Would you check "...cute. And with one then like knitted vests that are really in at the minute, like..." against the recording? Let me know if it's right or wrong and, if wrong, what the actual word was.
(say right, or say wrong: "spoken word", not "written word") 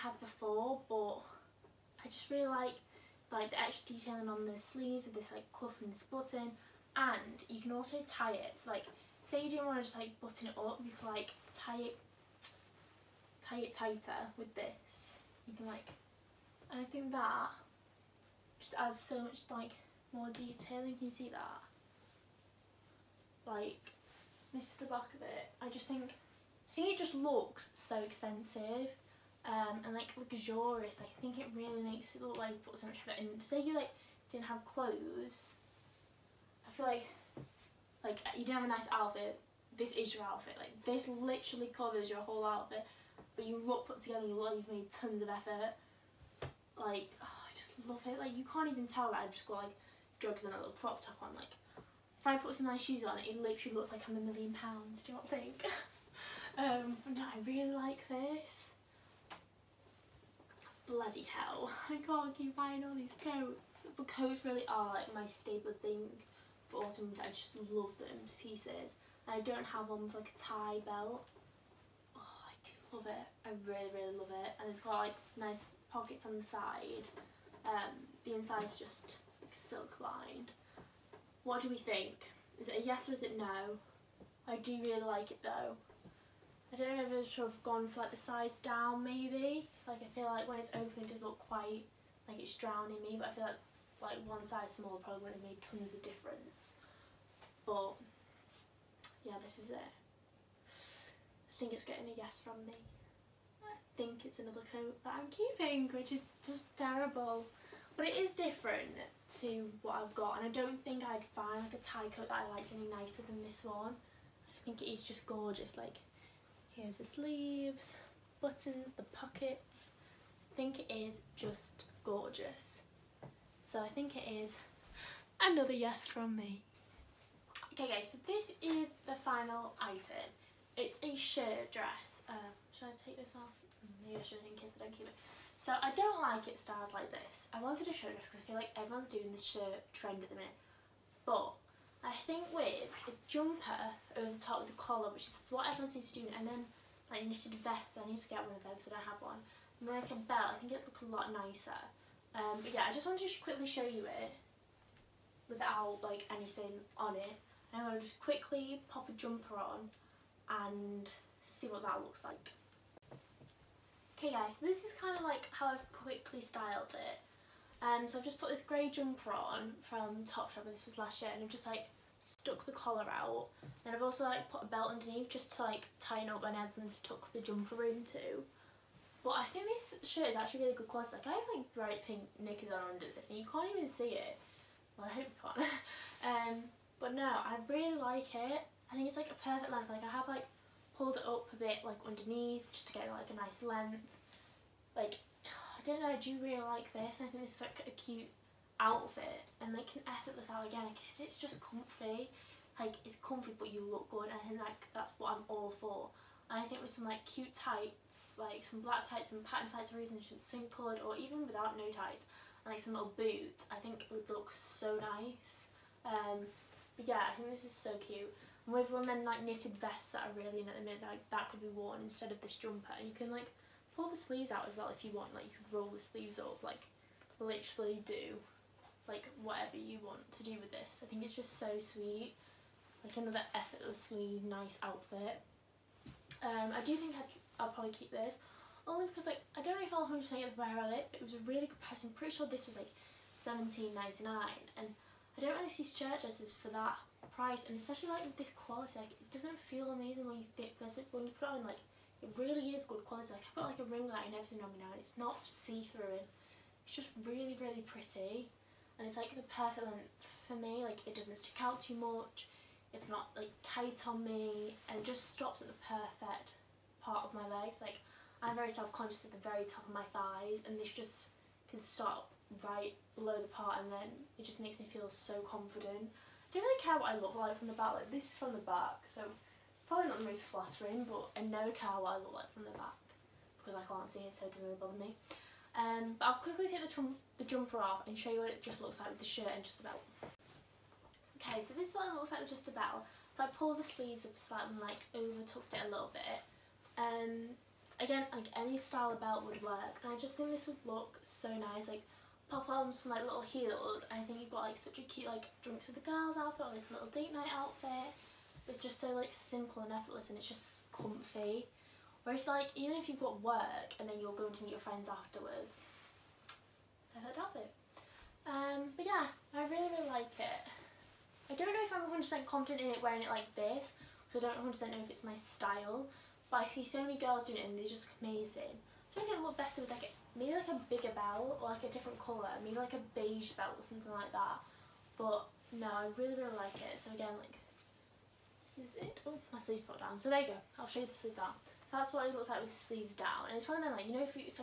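right.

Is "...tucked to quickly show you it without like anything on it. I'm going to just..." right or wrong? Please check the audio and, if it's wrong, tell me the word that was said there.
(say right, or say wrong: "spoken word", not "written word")
wrong: "wanted", not "tucked".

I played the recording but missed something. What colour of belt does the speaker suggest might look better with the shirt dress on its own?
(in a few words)
Beige.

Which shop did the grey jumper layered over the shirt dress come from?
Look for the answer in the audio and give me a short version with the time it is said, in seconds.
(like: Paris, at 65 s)
Topshop, at 170 s.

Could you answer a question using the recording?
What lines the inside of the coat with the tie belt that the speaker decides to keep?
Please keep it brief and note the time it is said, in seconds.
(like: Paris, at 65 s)
Silk, at 79 s.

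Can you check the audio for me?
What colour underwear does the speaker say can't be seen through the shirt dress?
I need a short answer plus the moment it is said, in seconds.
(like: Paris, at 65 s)
Bright pink, at 181 s.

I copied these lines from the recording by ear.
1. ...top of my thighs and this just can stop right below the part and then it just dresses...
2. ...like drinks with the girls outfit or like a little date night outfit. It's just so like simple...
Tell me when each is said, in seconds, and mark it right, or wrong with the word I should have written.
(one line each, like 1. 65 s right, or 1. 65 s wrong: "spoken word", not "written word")
1. 269 s wrong: "makes", not "dresses"
2. 305 s right.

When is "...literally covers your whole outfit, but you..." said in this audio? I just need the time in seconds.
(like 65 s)
41 s.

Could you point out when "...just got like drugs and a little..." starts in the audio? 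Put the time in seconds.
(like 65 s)
49 s.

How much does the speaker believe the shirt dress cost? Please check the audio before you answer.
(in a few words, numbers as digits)
17.99.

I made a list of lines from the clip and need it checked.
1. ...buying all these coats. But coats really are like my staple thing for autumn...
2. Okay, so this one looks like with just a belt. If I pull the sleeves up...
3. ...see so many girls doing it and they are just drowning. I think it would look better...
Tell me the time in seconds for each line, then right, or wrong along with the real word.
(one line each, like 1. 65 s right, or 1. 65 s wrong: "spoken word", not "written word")
1. 62 s right
2. 291 s right
3. 326 s wrong: "amazing", not "drowning".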